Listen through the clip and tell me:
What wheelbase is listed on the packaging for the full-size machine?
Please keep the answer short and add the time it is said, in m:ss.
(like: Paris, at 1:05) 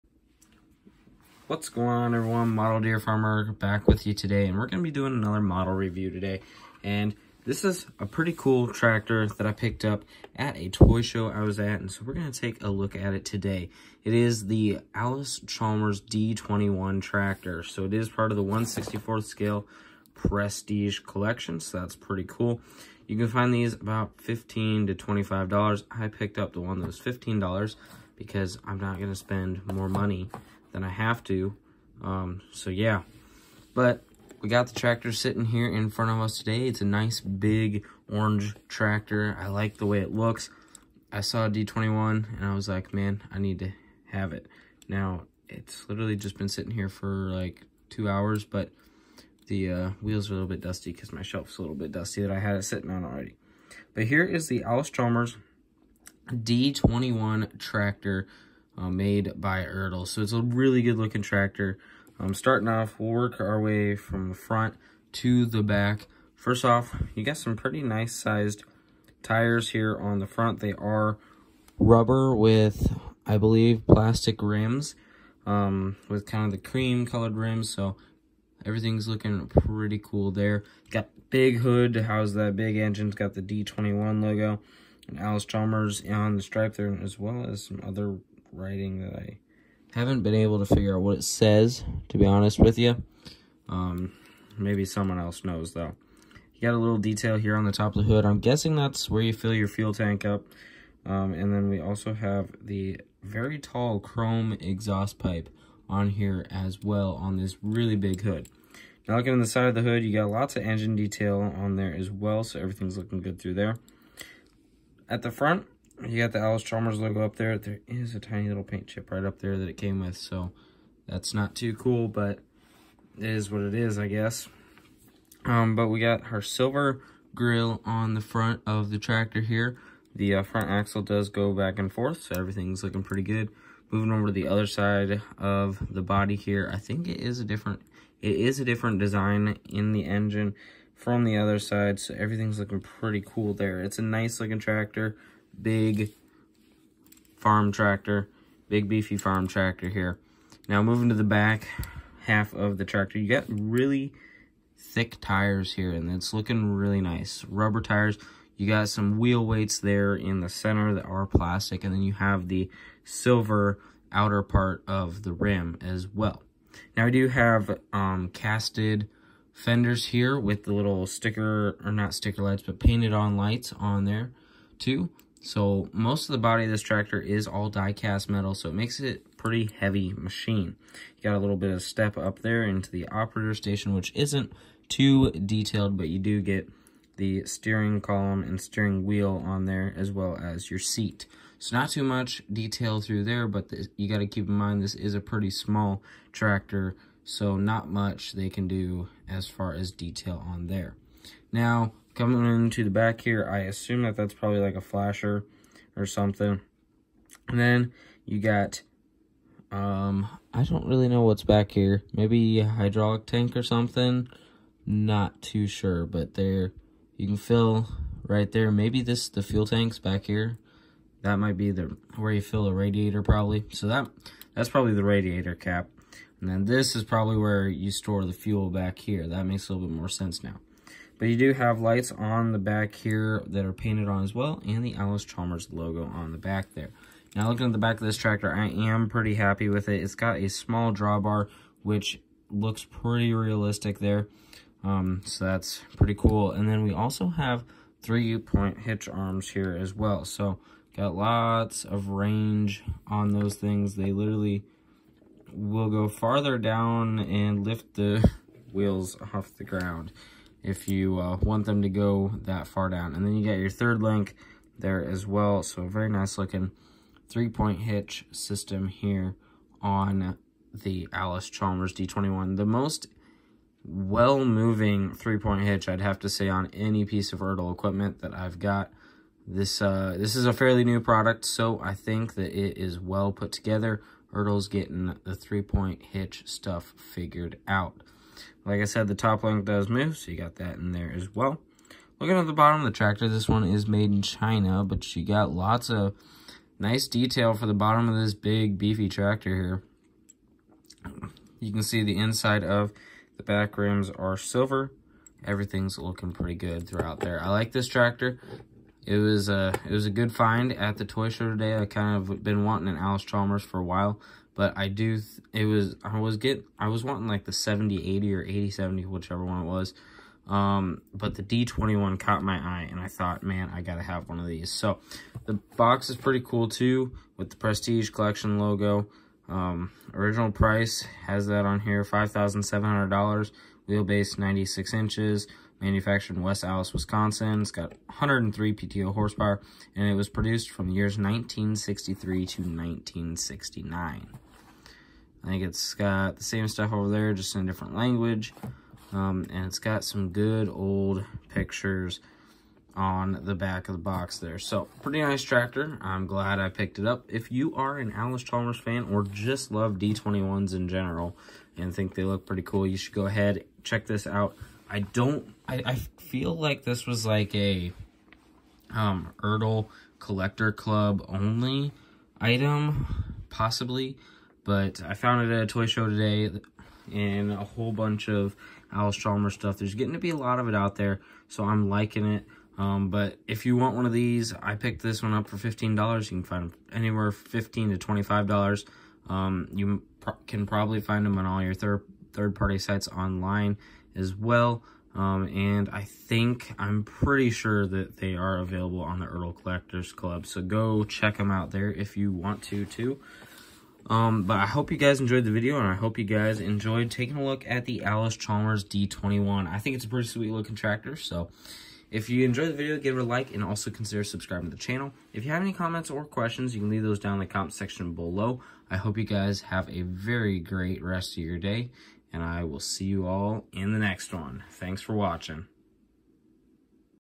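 96 inches, at 5:34.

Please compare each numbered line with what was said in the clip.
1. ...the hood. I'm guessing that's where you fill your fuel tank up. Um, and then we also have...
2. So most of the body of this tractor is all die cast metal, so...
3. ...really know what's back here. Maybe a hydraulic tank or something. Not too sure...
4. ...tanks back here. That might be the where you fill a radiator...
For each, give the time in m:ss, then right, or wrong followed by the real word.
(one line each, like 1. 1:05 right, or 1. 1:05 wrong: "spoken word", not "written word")
1. 1:38 right
2. 2:55 right
3. 3:30 right
4. 3:39 right.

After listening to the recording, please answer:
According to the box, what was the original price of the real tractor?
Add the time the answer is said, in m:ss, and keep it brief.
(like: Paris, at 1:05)
$5,700, at 5:32.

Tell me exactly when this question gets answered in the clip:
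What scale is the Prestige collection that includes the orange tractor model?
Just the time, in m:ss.
0:18.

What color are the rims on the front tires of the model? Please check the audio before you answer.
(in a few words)
Cream.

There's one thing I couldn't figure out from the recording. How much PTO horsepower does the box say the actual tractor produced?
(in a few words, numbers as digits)
103.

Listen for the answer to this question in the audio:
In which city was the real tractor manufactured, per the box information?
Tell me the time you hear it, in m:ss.
5:36.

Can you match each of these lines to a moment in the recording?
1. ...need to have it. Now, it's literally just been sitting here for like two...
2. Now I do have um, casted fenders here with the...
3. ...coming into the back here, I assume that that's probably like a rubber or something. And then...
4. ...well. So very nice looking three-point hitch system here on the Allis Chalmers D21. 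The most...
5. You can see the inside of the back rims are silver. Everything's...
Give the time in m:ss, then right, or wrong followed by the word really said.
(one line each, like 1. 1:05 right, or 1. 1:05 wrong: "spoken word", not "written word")
1. 0:43 right
2. 2:46 right
3. 3:22 wrong: "flasher", not "rubber"
4. 4:25 right
5. 5:01 right.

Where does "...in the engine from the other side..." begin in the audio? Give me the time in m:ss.
2:19.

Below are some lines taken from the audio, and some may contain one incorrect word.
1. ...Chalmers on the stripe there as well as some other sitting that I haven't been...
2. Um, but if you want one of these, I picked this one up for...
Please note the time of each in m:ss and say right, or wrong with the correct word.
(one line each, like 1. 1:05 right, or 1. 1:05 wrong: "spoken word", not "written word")
1. 1:25 wrong: "writing", not "sitting"
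2. 6:22 right.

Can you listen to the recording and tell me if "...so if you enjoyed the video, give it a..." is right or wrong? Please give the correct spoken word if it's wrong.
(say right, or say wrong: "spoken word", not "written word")
right.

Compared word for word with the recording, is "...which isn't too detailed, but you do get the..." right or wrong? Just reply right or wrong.
right.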